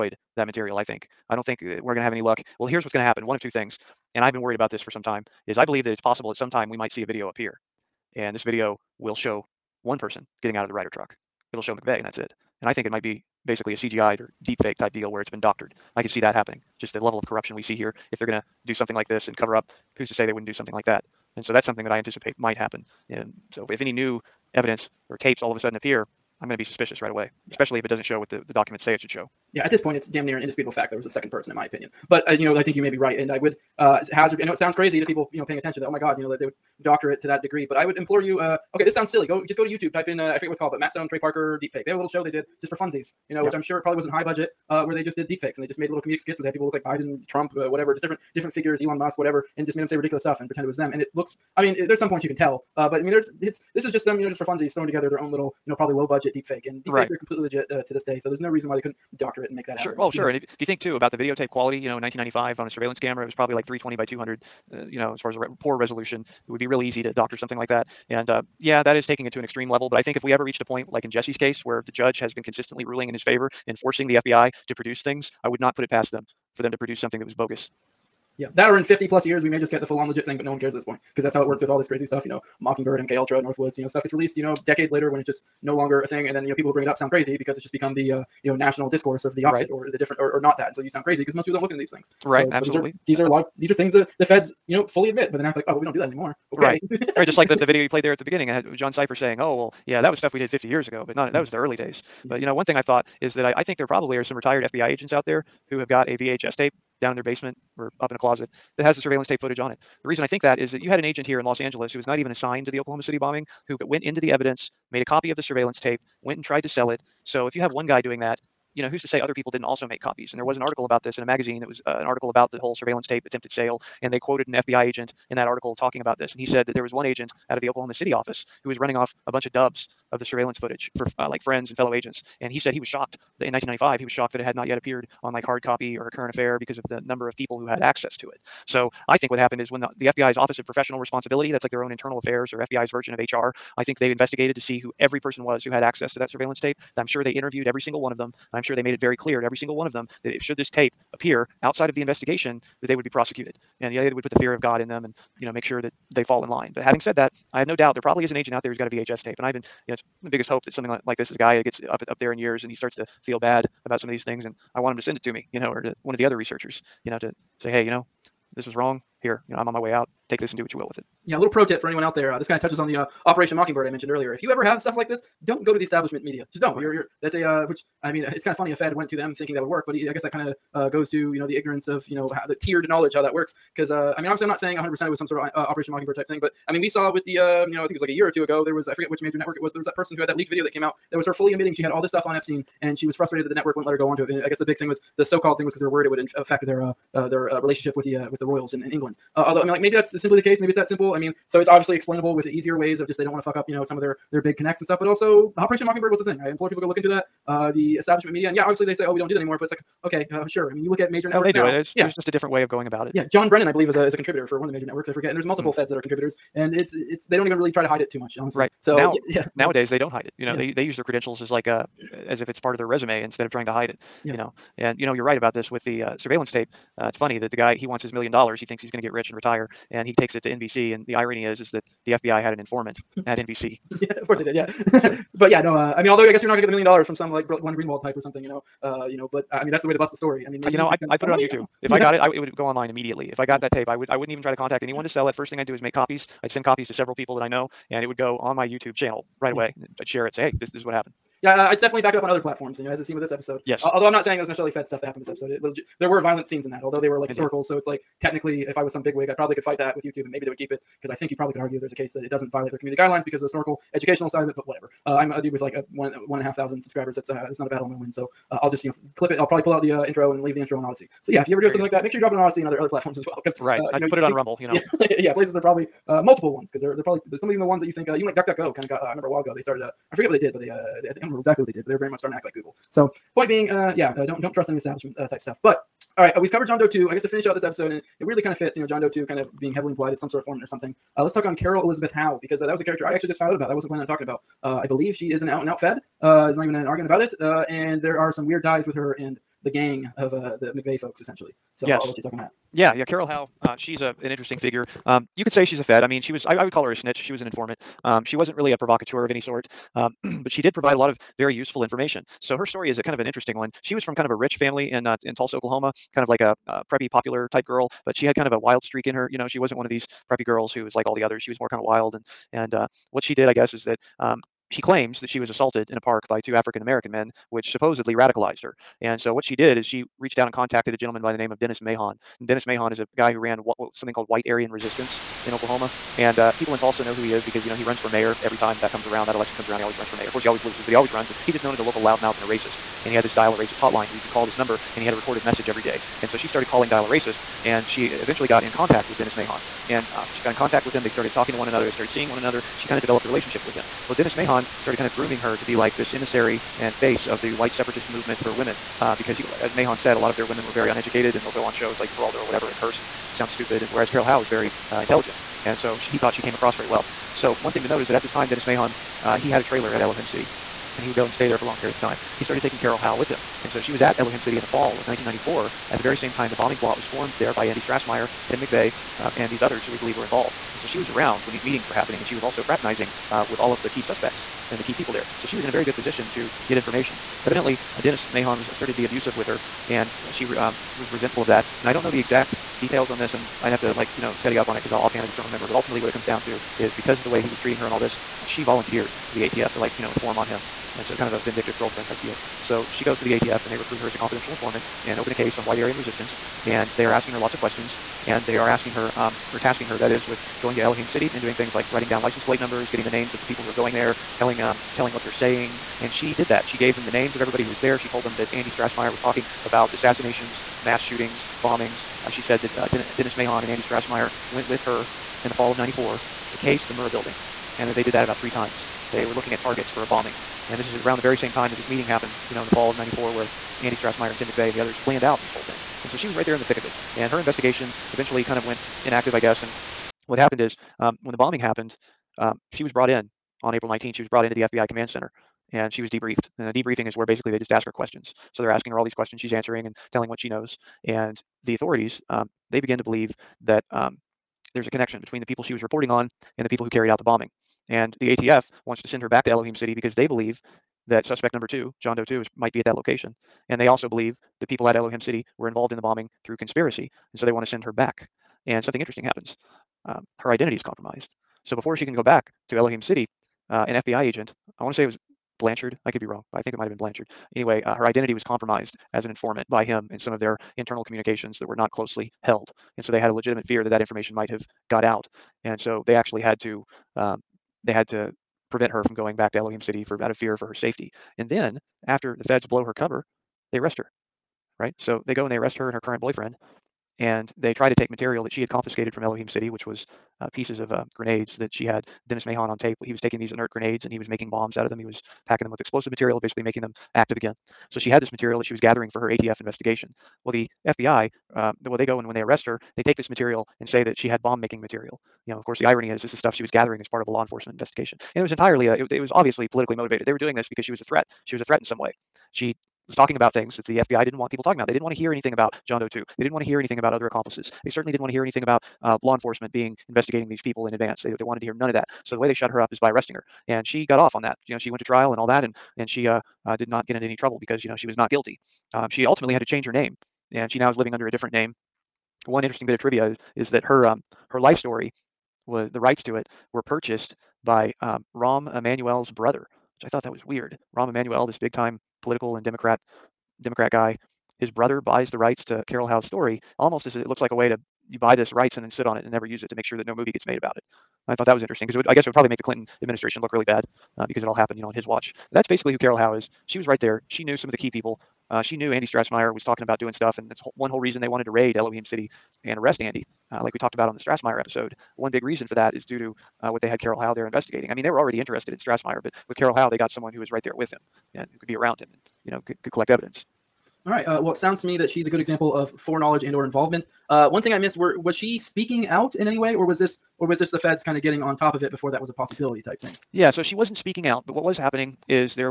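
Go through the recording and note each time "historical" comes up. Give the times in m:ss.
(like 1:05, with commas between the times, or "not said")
4:17, 4:23.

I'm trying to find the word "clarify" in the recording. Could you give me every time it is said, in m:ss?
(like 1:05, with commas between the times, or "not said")
not said.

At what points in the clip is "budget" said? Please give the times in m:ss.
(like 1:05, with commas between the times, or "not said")
0:44, 0:56.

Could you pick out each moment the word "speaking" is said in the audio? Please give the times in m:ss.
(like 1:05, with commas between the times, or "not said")
9:48, 9:53.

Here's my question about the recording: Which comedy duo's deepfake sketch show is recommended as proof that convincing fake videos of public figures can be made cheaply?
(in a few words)
Matt Stone, Trey Parker.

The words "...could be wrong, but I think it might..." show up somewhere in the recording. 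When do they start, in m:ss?
7:56.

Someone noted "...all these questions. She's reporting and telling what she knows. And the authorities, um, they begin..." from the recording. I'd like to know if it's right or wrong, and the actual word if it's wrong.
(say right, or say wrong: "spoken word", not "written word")
wrong: "answering", not "reporting".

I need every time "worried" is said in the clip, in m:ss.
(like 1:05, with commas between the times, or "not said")
0:04, 3:15.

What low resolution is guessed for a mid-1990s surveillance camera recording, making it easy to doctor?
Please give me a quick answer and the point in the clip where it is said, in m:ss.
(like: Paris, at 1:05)
320 by 200, at 1:03.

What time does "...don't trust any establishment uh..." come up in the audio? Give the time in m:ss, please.
4:44.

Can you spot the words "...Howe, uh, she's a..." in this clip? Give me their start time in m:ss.
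5:03.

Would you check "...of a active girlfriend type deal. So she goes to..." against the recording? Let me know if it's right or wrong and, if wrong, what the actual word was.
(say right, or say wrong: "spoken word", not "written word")
wrong: "vindictive", not "active".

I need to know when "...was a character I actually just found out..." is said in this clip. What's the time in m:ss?
4:52.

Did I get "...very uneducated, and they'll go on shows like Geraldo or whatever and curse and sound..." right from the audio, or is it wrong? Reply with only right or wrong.
right.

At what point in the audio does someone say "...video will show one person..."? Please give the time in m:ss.
0:08.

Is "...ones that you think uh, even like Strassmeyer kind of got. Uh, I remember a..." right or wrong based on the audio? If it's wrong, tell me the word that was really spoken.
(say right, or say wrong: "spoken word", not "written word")
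wrong: "DuckDuckGo", not "Strassmeyer".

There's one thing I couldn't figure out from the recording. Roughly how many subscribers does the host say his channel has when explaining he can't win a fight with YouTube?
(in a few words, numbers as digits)
1,500.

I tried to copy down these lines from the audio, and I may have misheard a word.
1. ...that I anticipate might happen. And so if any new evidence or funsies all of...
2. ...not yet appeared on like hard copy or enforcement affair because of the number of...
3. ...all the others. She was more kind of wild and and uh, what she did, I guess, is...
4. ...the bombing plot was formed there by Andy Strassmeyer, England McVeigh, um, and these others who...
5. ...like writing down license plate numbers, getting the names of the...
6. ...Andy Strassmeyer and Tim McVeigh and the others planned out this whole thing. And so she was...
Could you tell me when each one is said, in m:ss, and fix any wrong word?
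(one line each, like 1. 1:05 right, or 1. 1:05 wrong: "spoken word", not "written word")
1. 0:21 wrong: "tapes", not "funsies"
2. 2:14 wrong: "current", not "enforcement"
3. 5:21 right
4. 6:16 wrong: "Tim", not "England"
5. 6:51 right
6. 7:13 right.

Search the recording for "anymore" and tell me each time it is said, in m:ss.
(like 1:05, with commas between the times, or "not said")
1:36, 3:29.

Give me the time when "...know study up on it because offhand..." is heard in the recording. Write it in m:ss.
6:34.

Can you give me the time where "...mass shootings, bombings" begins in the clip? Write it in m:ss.
7:00.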